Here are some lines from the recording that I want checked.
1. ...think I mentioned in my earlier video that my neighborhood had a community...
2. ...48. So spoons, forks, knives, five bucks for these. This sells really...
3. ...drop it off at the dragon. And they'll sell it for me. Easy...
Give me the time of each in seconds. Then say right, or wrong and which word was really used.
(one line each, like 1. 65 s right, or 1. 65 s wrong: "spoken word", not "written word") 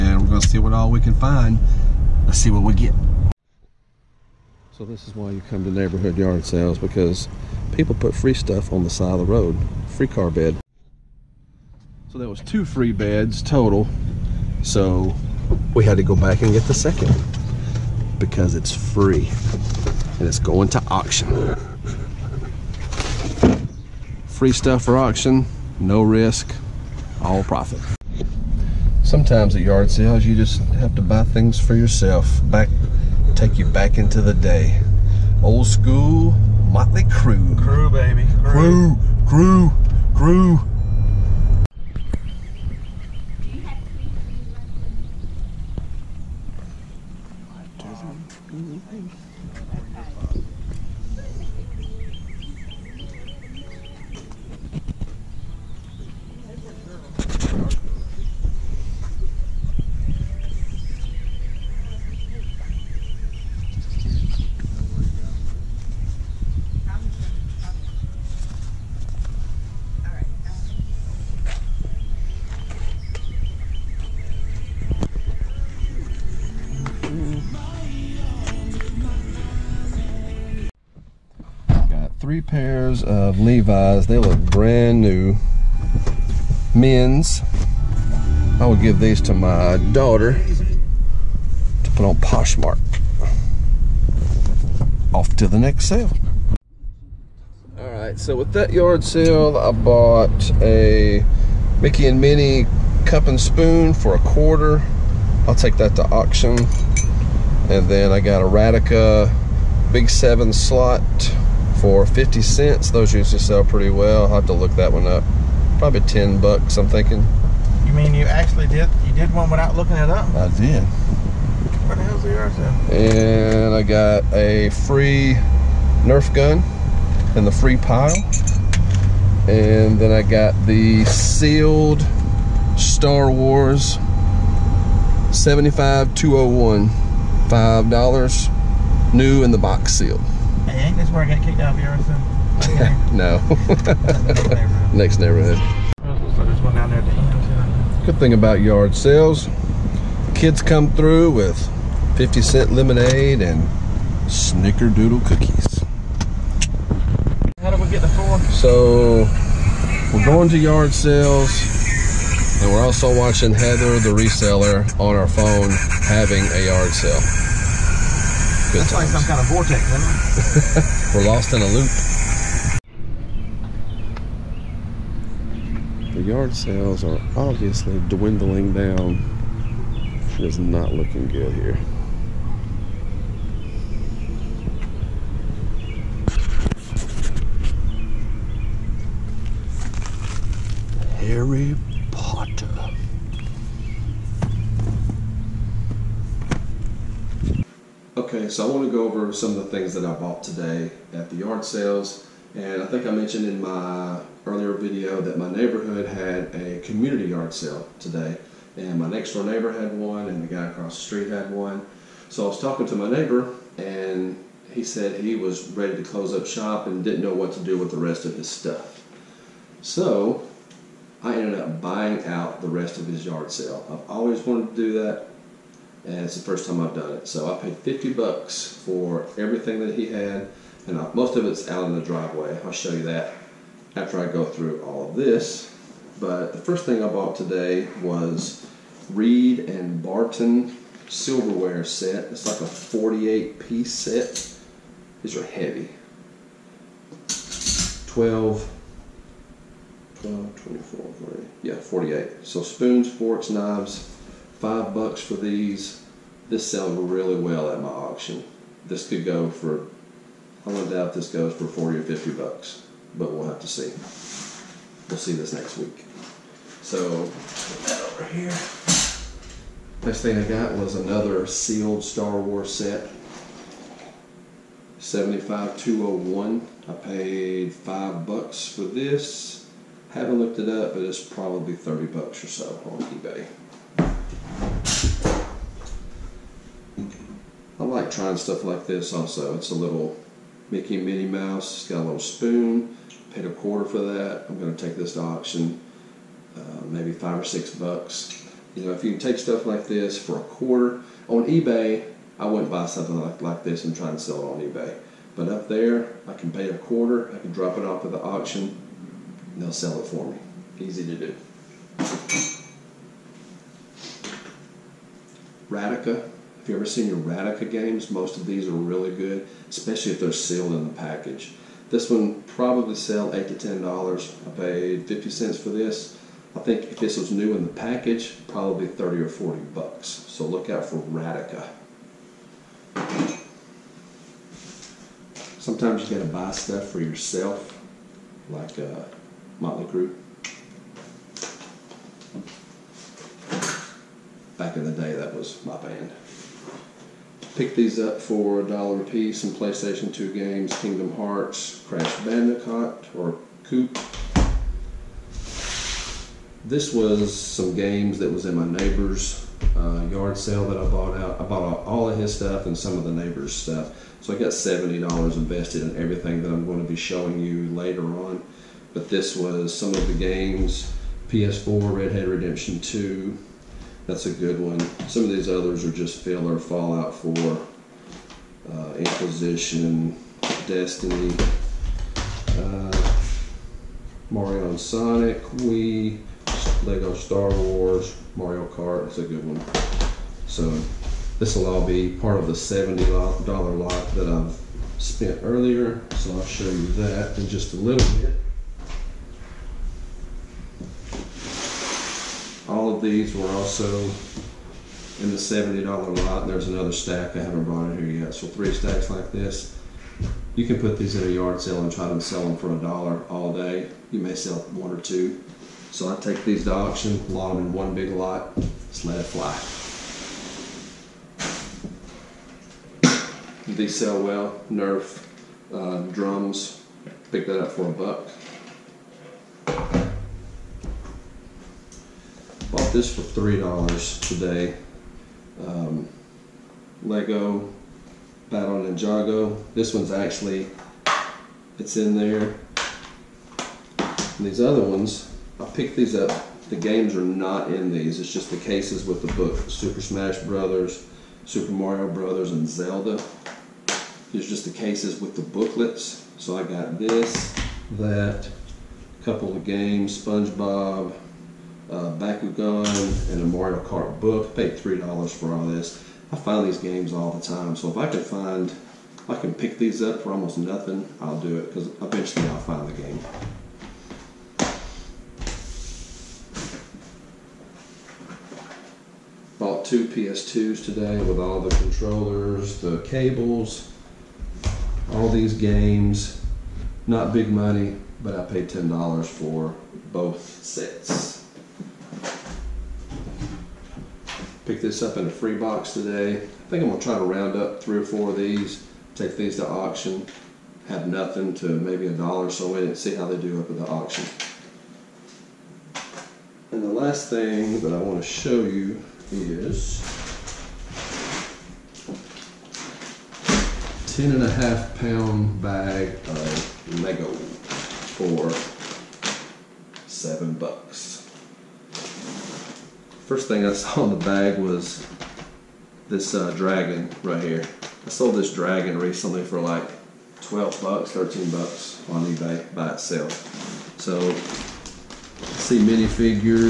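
1. 202 s right
2. 251 s right
3. 307 s wrong: "auction", not "dragon".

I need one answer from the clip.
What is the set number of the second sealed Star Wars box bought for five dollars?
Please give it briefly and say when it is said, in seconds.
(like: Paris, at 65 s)
75201, at 274 s.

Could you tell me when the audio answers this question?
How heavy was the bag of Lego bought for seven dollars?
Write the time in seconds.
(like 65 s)
514 s.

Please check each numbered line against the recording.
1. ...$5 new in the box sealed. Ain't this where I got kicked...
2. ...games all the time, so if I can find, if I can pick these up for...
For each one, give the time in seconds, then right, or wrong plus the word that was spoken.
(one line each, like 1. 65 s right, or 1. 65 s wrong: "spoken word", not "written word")
1. 136 s right
2. 466 s right.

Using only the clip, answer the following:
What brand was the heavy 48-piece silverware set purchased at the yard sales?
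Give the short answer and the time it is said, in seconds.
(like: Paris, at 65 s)
Reed and Barton, at 239 s.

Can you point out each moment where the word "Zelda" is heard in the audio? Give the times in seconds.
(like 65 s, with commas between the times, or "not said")
452 s.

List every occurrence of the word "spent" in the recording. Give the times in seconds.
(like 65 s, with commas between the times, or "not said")
395 s.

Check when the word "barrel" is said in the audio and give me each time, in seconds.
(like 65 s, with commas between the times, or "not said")
not said.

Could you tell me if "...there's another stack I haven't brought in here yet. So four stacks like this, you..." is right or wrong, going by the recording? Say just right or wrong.
wrong.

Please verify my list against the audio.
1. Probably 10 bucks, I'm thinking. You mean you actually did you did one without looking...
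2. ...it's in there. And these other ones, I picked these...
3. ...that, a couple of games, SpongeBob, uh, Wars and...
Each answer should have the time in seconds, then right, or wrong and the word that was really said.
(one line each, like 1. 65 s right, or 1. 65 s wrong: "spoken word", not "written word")
1. 115 s right
2. 441 s right
3. 457 s wrong: "Bakugan", not "Wars".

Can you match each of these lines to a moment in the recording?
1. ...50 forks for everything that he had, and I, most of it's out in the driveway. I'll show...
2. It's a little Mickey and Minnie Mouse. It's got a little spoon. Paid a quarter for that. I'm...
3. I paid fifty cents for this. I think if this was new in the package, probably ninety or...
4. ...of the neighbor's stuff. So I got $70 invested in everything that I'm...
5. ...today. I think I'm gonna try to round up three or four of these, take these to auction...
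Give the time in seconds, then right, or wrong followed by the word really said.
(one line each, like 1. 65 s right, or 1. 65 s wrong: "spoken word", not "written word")
1. 227 s wrong: "bucks", not "forks"
2. 289 s right
3. 324 s wrong: "thirty", not "ninety"
4. 362 s right
5. 495 s right.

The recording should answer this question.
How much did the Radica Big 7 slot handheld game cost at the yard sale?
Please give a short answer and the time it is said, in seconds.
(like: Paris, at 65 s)
50 cents, at 112 s.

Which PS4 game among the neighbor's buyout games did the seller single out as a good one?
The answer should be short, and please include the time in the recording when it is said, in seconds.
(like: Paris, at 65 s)
Red Dead Redemption 2, at 372 s.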